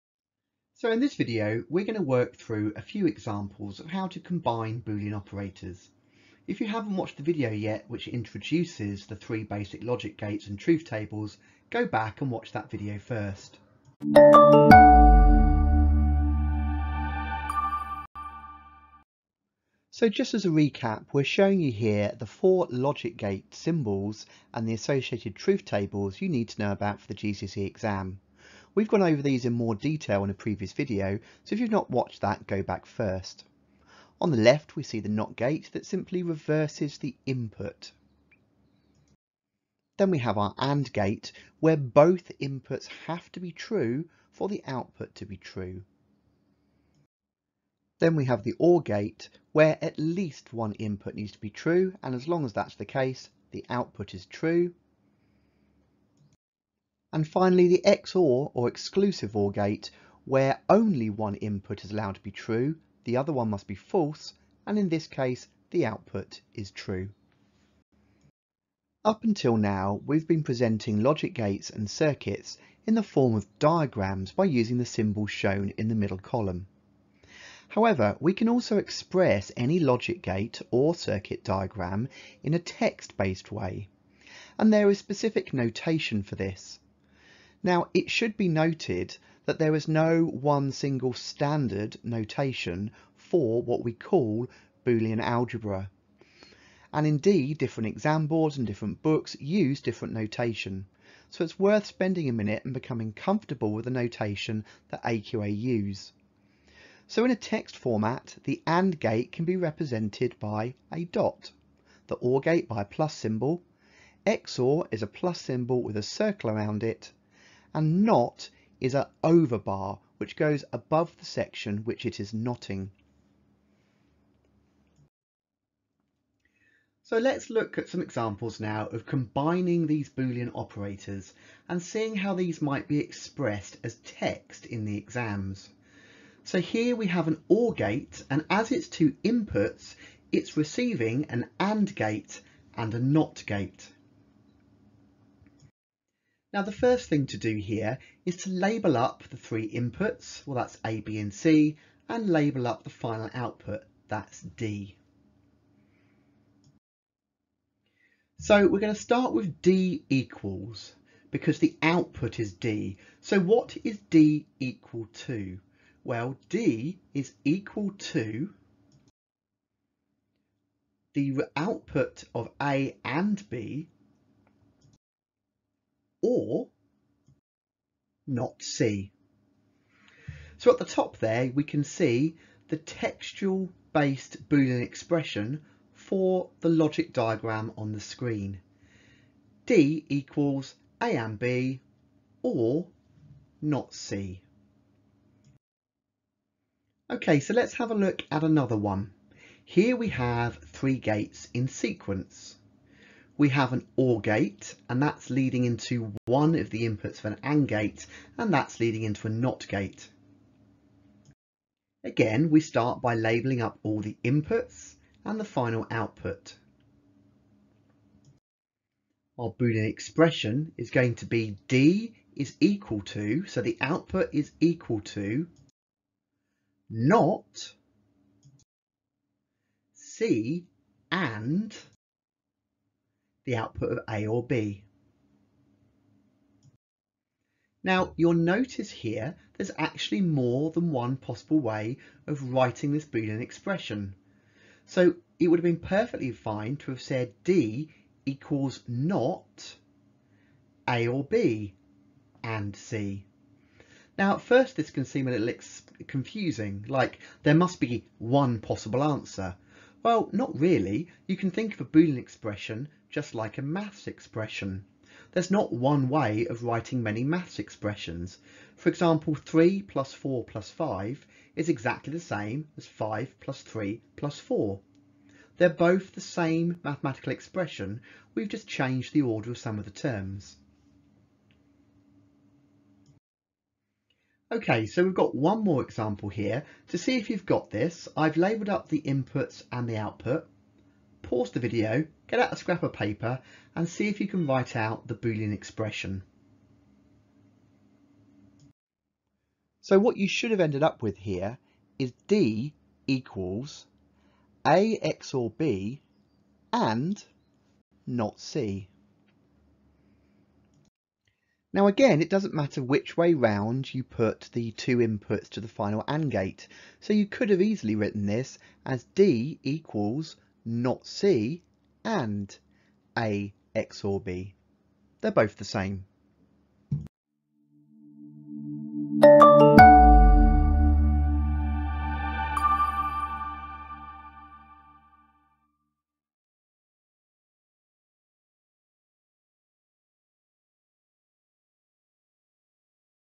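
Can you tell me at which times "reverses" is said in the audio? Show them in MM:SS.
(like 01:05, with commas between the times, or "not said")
00:36.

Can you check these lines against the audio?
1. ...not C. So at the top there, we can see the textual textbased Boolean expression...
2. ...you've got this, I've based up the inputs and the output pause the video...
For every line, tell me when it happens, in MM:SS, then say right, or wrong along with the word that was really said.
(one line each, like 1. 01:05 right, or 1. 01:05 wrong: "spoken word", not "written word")
1. 02:58 wrong: "based", not "textbased"
2. 04:47 wrong: "labelled", not "based".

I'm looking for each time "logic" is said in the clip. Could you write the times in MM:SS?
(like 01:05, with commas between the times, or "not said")
00:09, 00:22, 01:11, 01:19, 03:06.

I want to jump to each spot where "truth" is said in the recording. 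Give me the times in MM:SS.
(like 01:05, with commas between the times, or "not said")
00:10, 00:25.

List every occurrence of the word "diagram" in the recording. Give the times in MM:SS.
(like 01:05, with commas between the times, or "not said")
01:13, 01:21, 03:07.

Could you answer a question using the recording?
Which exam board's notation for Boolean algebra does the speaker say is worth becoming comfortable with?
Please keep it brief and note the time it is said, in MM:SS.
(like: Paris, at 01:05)
AQA, at 01:45.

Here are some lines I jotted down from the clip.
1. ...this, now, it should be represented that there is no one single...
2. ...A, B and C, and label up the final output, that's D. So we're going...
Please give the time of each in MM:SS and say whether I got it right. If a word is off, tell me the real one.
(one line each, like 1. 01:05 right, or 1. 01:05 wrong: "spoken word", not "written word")
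1. 01:26 wrong: "noted", not "represented"
2. 02:30 right.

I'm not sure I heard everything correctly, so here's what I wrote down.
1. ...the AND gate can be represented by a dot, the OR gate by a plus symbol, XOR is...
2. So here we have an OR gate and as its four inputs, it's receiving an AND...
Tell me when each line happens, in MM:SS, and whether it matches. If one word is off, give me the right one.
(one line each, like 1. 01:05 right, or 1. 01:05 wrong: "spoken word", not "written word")
1. 01:48 right
2. 02:16 wrong: "two", not "four".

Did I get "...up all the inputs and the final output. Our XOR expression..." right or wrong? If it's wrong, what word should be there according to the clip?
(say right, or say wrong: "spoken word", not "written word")
wrong: "Boolean", not "XOR".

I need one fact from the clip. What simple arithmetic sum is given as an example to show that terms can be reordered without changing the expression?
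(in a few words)
3 plus 4 plus 5.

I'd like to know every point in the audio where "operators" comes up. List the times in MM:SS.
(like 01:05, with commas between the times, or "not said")
00:05, 02:10.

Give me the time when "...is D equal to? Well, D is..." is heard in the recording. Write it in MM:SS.
02:43.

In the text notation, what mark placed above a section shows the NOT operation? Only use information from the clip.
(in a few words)
An overbar.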